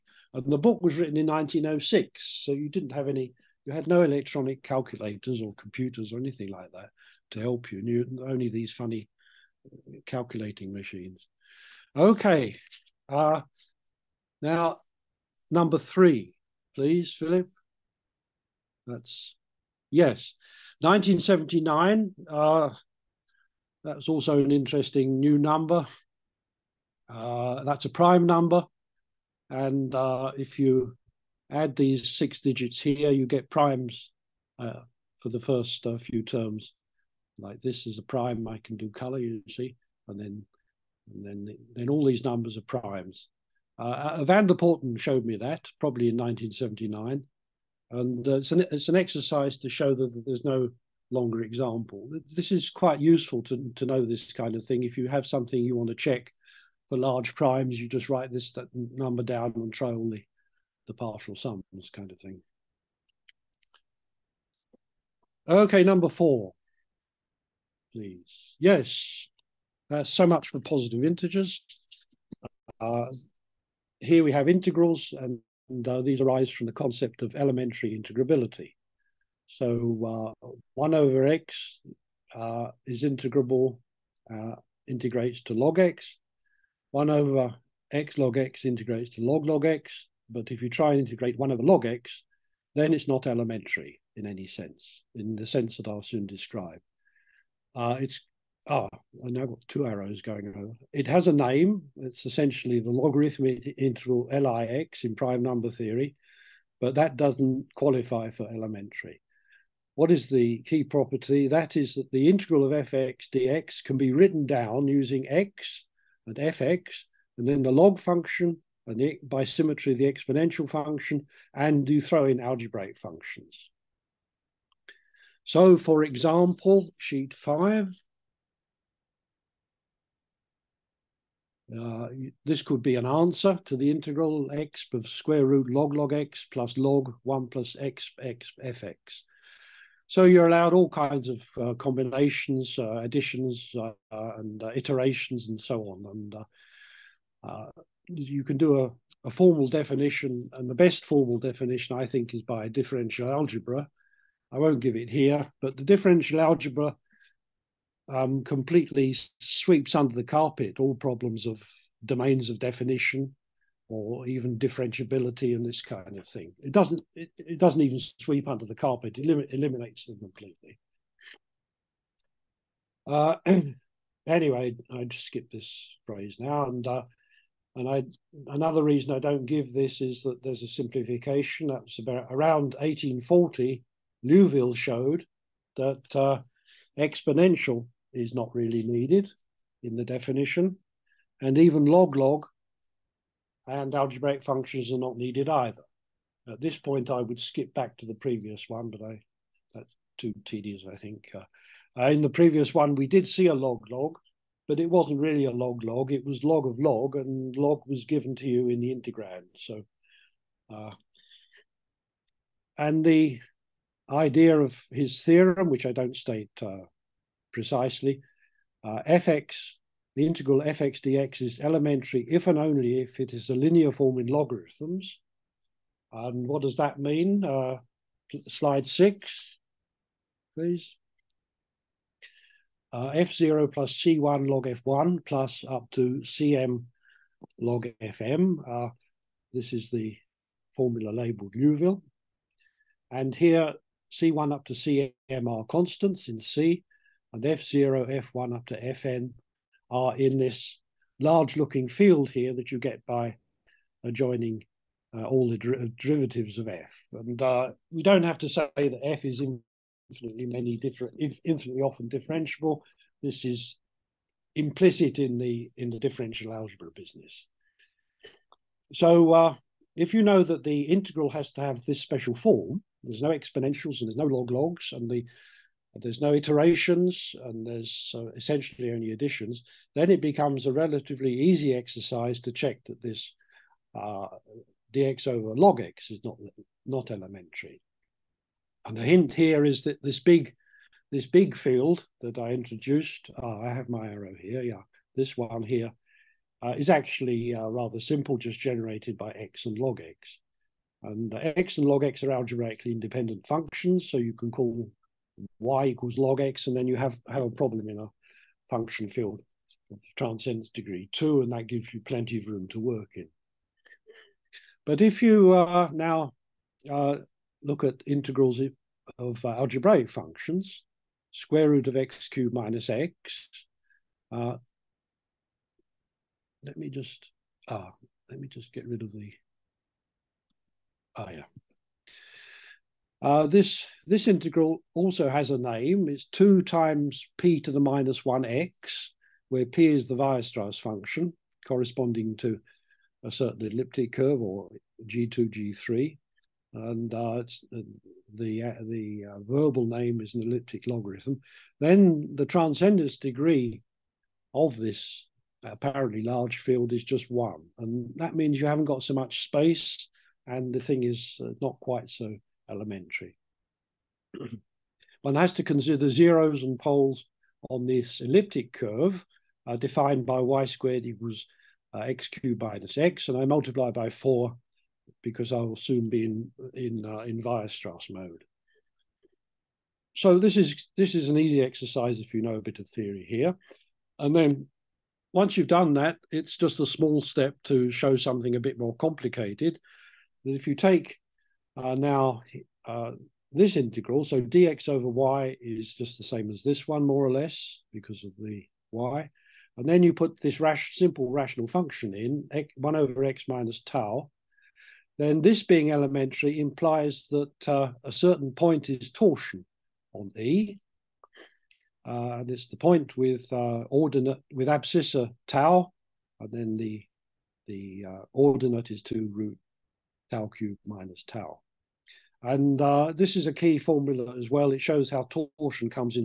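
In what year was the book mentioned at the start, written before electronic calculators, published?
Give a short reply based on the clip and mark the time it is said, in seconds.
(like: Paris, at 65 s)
1906, at 1 s.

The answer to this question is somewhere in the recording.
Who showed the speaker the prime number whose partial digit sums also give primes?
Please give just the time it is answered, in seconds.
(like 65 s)
44 s.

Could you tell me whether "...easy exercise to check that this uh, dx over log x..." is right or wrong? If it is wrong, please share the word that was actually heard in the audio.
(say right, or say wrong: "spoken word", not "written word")
right.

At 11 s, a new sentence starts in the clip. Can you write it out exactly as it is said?
Okay, uh, now number three, please, Philip.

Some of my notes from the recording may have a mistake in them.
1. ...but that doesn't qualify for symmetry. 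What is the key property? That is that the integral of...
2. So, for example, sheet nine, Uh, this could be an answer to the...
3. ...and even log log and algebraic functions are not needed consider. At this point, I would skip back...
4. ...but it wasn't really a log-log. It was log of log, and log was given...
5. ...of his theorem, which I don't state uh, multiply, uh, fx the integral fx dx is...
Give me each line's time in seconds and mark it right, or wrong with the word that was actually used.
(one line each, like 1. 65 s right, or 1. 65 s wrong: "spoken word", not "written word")
1. 106 s wrong: "elementary", not "symmetry"
2. 125 s wrong: "five", not "nine"
3. 191 s wrong: "either", not "consider"
4. 204 s right
5. 214 s wrong: "precisely", not "multiply".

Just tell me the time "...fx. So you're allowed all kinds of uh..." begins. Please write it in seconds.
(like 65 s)
138 s.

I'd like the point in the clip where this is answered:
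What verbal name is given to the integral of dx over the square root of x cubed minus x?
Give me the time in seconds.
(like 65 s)
350 s.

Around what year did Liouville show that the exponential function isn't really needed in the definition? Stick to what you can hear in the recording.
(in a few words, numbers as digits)
1840.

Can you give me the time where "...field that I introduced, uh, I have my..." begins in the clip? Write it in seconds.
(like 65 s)
291 s.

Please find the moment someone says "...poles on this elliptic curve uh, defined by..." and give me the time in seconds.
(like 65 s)
366 s.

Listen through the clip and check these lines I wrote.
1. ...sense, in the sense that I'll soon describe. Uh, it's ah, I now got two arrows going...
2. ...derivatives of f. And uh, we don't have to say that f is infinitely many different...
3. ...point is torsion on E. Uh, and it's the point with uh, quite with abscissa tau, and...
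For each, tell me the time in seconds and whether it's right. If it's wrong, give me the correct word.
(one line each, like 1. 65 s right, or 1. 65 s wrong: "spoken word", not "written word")
1. 94 s right
2. 255 s right
3. 408 s wrong: "ordinate", not "quite".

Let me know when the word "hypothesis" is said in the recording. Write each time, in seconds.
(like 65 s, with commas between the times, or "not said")
not said.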